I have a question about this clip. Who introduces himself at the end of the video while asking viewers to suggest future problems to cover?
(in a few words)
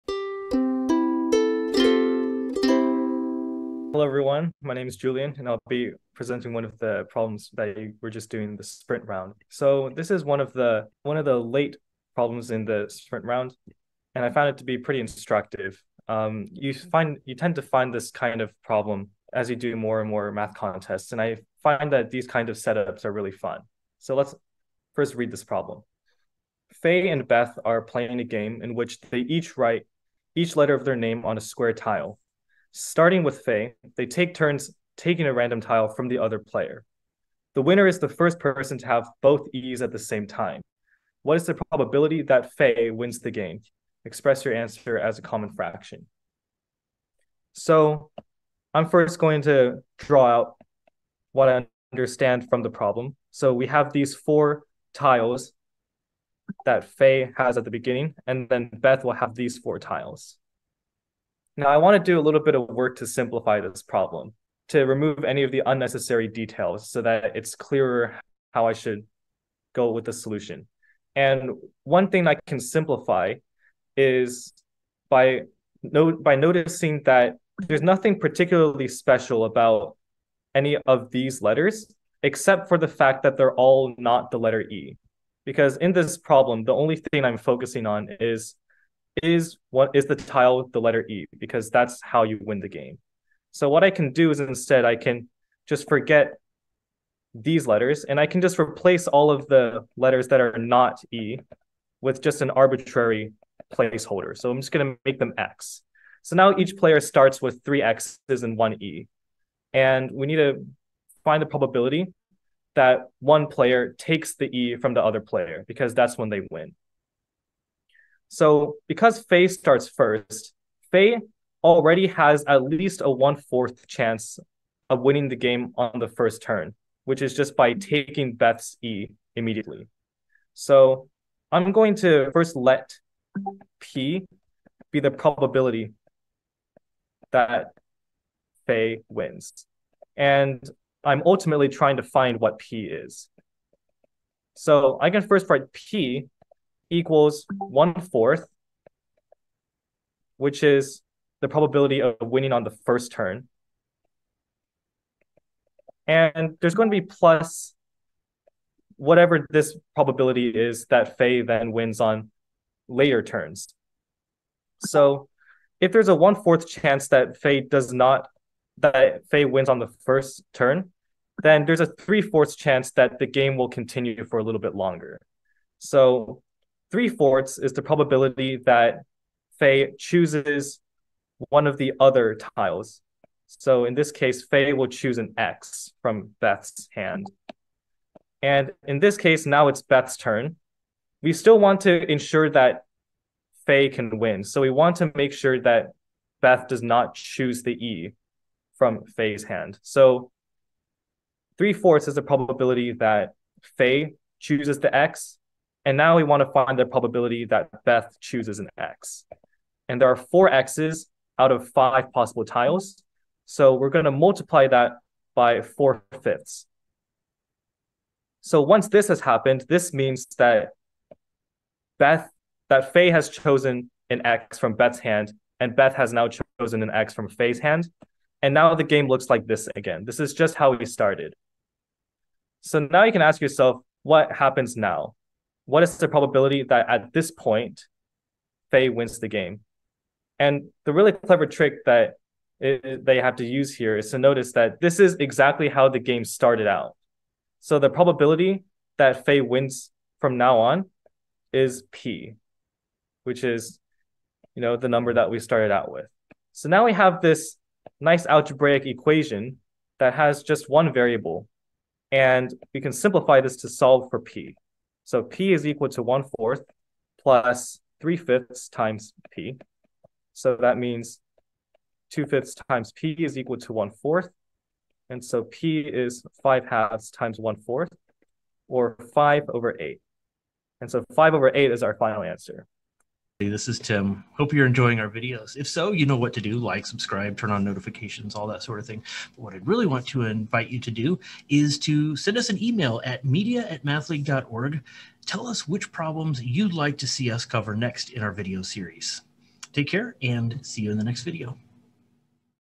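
Tim.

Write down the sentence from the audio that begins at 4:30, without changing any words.
So that means two fifths times P is equal to one fourth.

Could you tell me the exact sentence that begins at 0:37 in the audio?
The winner is the first person to have both E's at the same time.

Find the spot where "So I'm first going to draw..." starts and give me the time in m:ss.
0:47.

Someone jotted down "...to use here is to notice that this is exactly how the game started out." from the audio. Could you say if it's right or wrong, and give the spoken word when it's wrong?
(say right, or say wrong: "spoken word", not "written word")
right.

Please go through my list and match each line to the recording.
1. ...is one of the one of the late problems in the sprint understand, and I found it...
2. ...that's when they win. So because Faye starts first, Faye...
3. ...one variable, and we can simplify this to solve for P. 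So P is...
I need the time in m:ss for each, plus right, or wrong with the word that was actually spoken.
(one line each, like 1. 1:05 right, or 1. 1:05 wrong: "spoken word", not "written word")
1. 0:10 wrong: "round", not "understand"
2. 1:55 right
3. 4:20 right.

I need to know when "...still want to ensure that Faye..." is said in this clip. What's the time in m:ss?
3:11.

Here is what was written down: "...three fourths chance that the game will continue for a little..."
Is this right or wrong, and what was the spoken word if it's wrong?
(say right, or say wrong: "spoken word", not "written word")
right.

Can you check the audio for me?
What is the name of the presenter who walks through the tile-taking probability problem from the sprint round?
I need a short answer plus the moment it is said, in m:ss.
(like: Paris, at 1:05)
Julian, at 0:04.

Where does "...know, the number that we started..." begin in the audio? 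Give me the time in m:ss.
4:14.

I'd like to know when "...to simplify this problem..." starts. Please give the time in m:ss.
1:02.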